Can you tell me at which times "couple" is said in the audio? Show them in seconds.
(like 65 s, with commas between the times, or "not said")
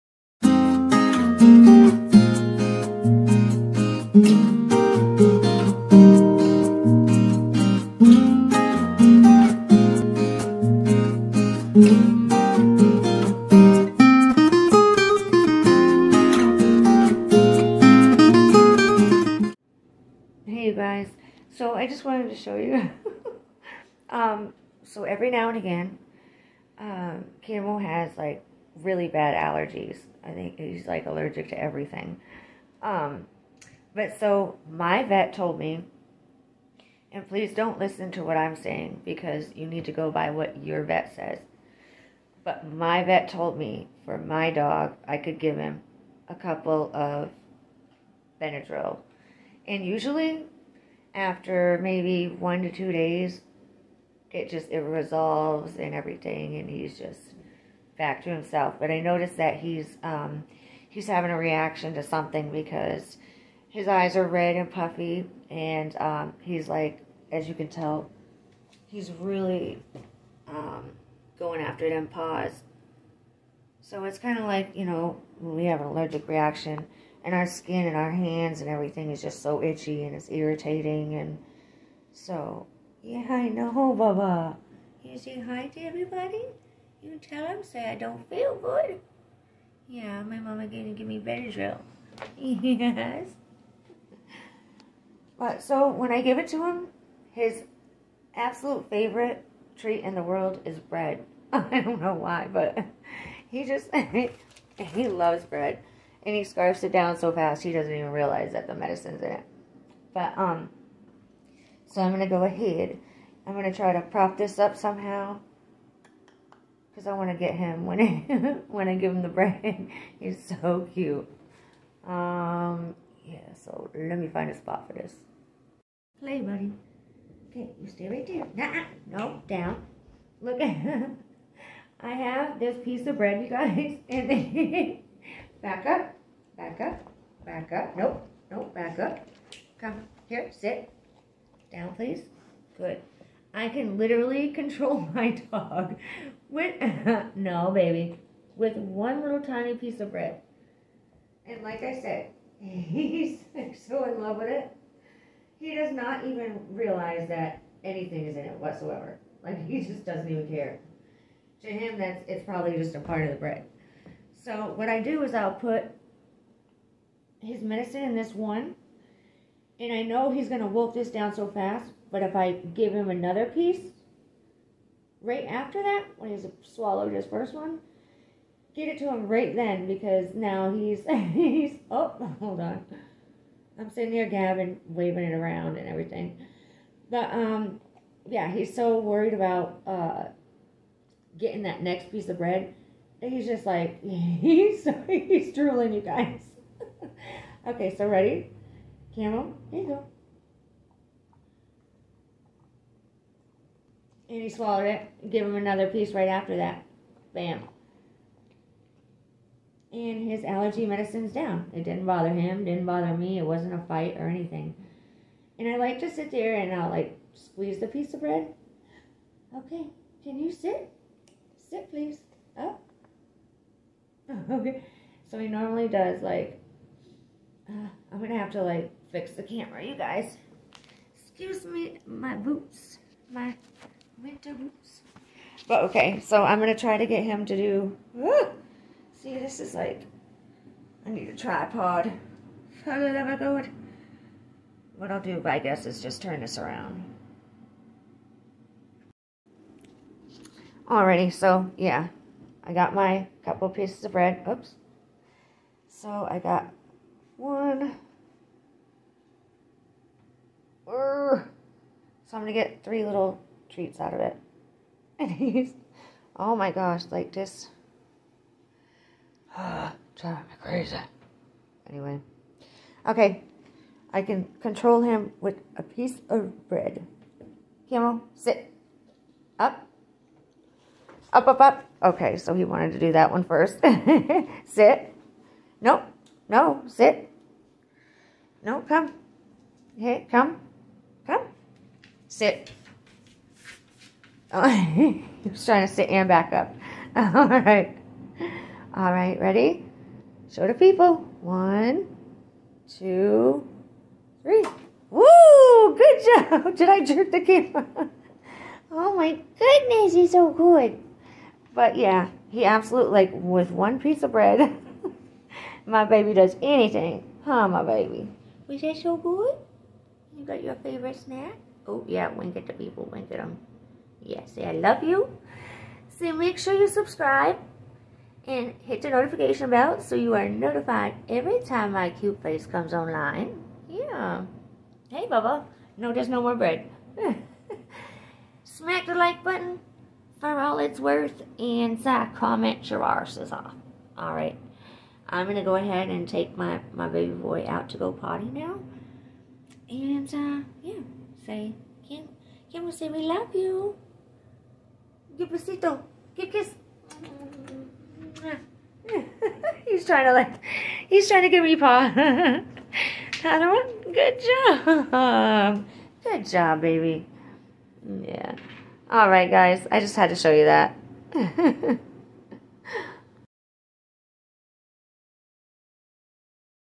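46 s, 253 s.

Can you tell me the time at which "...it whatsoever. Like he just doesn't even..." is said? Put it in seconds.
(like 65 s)
158 s.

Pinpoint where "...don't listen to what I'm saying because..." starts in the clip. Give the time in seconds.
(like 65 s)
37 s.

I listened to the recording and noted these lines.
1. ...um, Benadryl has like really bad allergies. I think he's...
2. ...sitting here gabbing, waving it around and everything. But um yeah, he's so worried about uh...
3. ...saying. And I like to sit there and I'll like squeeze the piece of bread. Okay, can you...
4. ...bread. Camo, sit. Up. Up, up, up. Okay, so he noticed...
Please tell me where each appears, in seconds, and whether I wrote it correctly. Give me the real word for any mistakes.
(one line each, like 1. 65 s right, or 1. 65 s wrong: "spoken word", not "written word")
1. 26 s wrong: "Camo", not "Benadryl"
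2. 183 s right
3. 214 s wrong: "anything", not "saying"
4. 276 s wrong: "wanted", not "noticed".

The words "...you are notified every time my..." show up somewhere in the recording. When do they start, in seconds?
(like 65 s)
330 s.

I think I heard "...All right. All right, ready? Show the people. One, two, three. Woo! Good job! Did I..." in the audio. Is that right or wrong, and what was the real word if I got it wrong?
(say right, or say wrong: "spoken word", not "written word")
right.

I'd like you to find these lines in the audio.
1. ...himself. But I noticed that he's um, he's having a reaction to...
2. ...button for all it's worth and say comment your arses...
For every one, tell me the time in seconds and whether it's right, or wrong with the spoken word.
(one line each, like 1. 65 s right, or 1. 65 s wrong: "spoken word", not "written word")
1. 58 s right
2. 339 s right.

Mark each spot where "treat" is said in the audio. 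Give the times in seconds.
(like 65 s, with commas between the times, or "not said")
99 s, 263 s.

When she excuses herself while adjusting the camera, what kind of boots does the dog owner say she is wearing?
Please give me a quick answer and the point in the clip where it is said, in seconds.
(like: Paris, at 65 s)
winter boots, at 234 s.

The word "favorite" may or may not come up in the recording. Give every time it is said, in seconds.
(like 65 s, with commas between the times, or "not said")
98 s, 320 s.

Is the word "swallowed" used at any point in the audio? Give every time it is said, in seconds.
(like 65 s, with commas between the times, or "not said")
176 s, 204 s.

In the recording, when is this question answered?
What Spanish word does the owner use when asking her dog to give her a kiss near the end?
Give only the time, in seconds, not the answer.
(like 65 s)
355 s.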